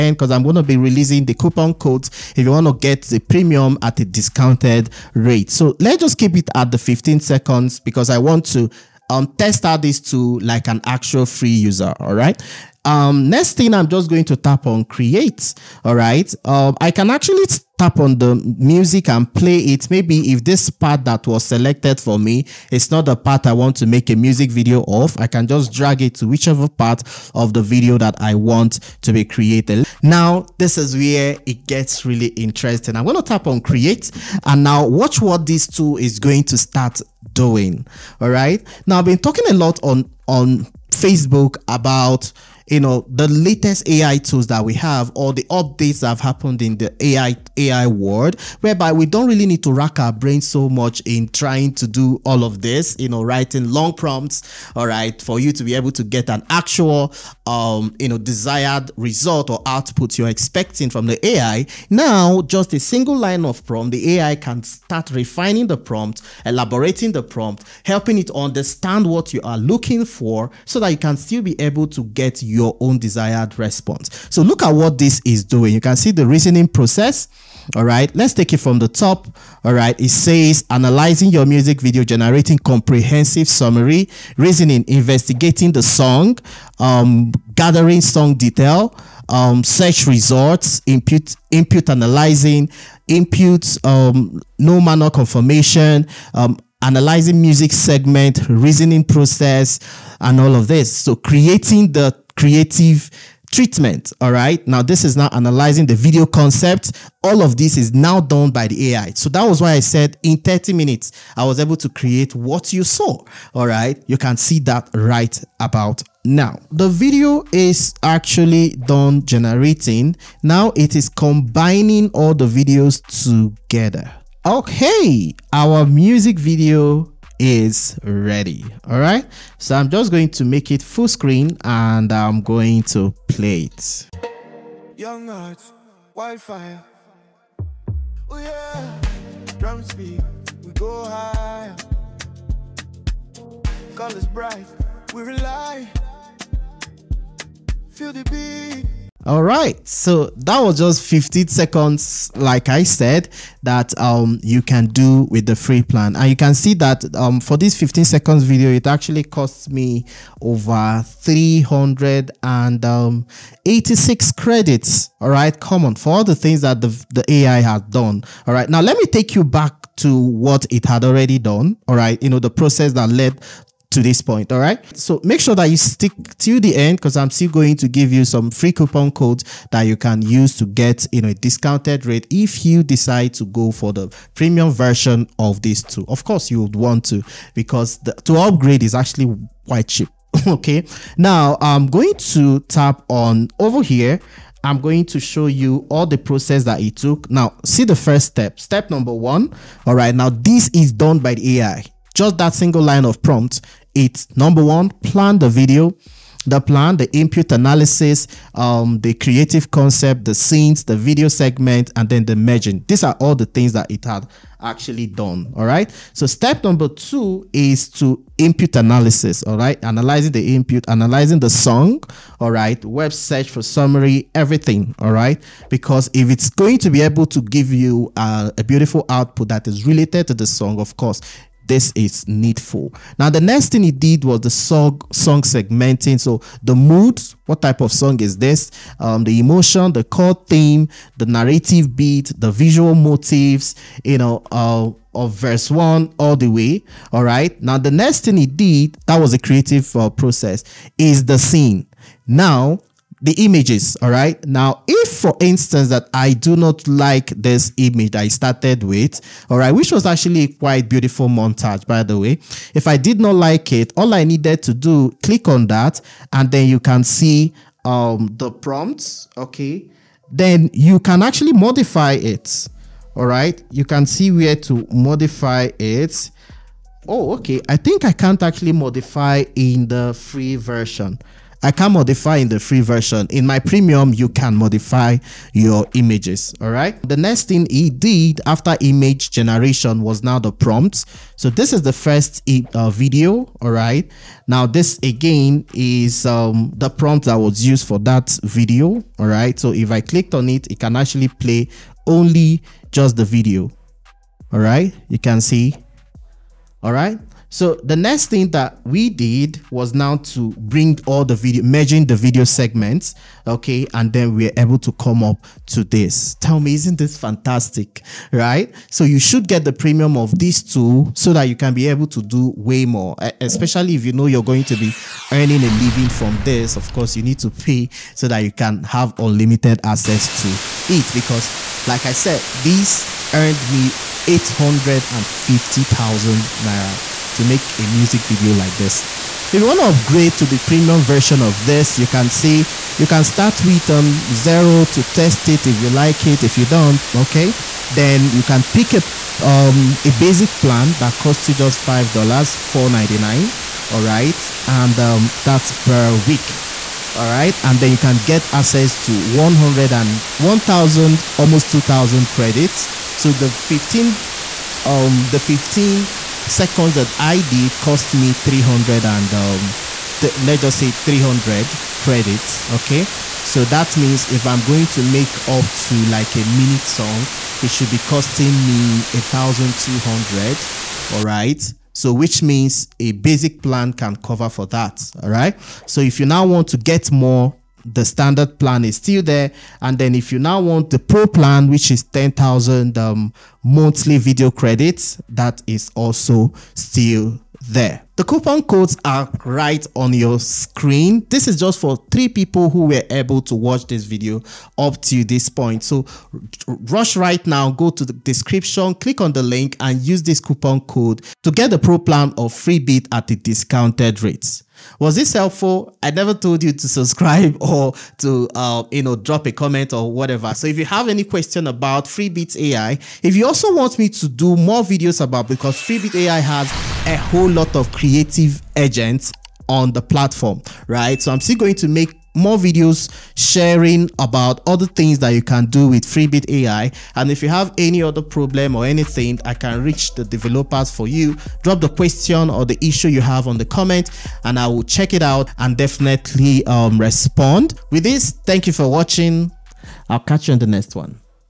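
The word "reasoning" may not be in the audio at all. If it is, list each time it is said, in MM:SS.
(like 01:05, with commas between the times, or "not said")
01:16, 01:24, 01:38.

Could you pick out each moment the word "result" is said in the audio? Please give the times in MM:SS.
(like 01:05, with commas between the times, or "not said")
00:58, 01:30.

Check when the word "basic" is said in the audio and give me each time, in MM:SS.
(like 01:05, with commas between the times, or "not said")
05:50, 06:23.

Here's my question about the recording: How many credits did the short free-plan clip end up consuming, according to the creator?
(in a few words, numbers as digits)
386.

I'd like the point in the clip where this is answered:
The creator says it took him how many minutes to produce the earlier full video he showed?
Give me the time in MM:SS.
01:50.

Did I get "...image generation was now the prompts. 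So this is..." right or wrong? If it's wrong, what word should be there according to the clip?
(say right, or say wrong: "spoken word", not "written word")
right.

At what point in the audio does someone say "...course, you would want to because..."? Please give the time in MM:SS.
03:06.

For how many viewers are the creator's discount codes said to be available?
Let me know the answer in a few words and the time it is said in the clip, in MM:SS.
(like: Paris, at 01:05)
3, at 06:42.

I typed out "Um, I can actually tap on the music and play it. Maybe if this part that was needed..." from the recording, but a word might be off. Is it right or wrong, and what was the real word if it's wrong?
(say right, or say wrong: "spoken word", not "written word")
wrong: "selected", not "needed".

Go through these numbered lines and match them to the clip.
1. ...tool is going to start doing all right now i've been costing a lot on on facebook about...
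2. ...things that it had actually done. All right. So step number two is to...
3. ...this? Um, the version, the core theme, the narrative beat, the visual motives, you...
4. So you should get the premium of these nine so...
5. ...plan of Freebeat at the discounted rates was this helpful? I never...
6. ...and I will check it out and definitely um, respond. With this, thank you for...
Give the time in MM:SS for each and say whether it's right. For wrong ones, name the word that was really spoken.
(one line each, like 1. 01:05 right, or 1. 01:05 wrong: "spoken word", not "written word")
1. 00:35 wrong: "talking", not "costing"
2. 03:33 right
3. 03:58 wrong: "emotion", not "version"
4. 05:18 wrong: "two", not "nine"
5. 06:51 right
6. 07:24 right.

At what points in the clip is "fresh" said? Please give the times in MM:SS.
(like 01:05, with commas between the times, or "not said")
not said.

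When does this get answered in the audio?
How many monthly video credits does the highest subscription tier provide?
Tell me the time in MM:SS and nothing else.
06:32.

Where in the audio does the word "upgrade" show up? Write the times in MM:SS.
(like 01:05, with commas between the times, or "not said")
03:08, 05:39.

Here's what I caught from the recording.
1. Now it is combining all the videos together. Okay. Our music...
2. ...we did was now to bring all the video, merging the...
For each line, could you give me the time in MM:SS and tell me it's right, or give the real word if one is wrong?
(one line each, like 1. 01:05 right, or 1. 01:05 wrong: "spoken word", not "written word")
1. 02:00 right
2. 05:08 right.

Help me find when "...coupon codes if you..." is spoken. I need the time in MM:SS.
00:01.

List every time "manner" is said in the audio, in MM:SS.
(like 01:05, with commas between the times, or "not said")
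01:34.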